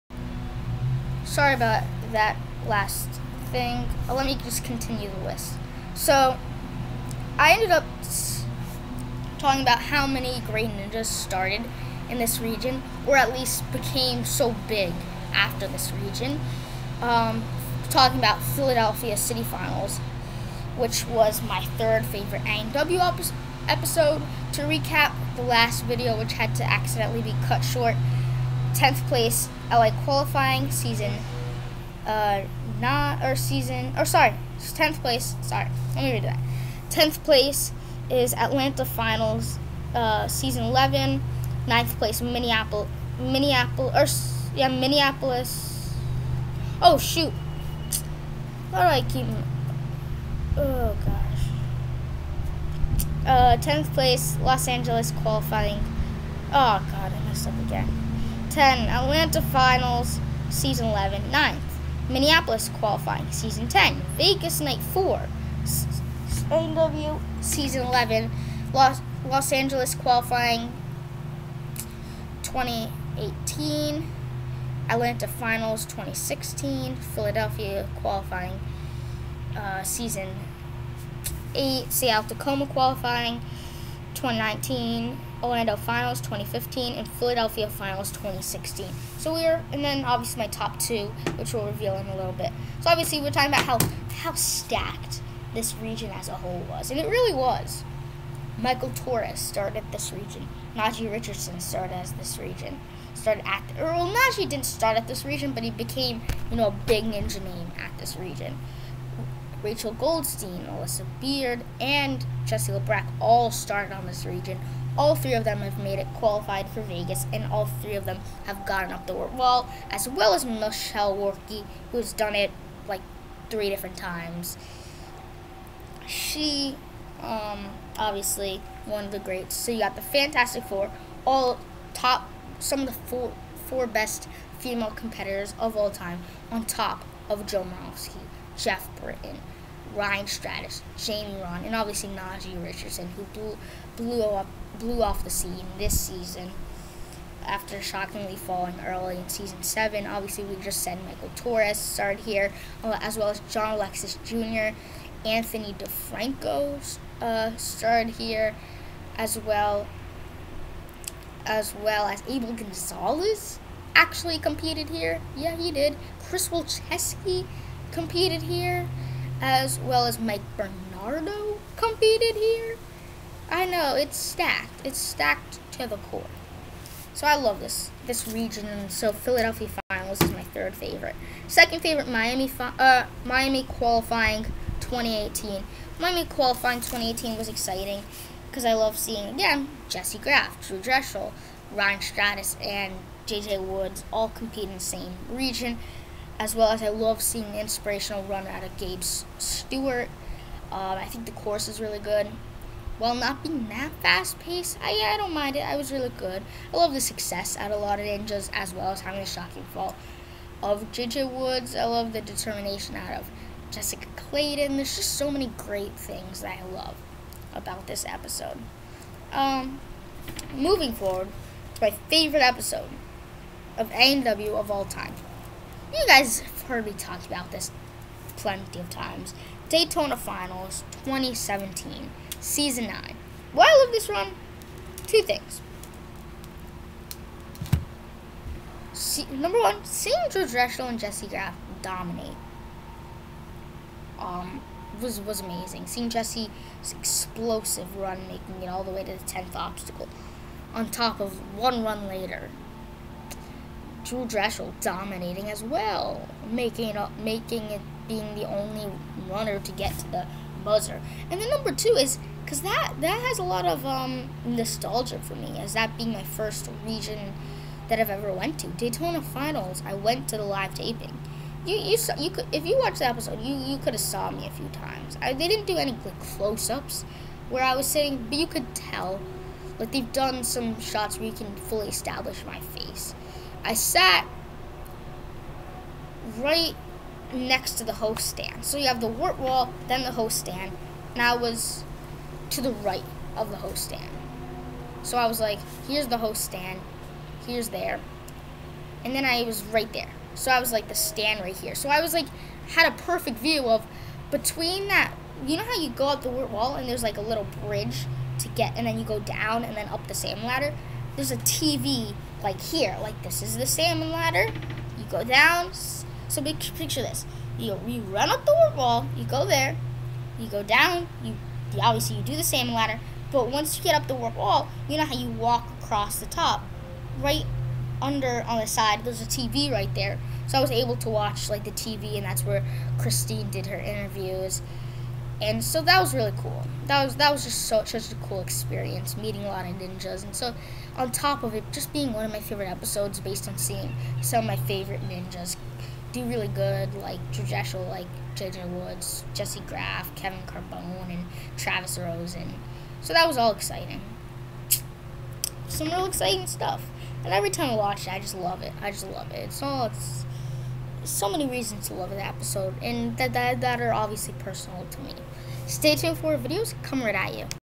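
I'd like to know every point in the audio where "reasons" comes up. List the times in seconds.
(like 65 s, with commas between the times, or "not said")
361 s.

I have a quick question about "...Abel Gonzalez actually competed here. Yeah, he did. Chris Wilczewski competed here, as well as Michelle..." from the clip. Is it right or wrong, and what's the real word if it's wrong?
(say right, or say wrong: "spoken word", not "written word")
wrong: "Mike", not "Michelle".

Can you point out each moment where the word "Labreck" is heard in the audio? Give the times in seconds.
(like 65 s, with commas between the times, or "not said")
112 s.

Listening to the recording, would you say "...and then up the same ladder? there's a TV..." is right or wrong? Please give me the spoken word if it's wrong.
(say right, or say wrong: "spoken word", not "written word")
right.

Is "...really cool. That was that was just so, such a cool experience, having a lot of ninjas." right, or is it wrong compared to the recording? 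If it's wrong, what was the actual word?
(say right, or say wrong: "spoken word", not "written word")
wrong: "meeting", not "having".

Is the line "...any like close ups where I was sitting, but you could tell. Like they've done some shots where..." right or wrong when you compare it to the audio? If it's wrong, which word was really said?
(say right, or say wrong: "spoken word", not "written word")
right.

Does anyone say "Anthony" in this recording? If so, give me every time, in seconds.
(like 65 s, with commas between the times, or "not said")
155 s.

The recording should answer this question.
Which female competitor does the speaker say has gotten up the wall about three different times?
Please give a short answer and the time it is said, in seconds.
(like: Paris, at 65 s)
Michelle Warnky, at 120 s.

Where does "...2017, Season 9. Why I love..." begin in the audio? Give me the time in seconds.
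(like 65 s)
231 s.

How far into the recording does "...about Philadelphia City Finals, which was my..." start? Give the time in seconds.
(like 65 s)
18 s.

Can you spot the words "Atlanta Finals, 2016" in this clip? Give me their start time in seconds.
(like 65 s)
74 s.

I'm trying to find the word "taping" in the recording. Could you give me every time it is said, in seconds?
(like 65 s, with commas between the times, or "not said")
270 s.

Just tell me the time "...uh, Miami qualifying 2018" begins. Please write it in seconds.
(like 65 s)
182 s.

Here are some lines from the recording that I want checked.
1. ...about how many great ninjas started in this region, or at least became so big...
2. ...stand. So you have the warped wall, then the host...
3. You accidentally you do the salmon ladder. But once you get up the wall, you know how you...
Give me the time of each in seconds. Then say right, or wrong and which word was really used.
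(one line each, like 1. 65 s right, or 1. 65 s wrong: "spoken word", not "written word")
1. 9 s right
2. 288 s right
3. 321 s wrong: "obviously", not "accidentally".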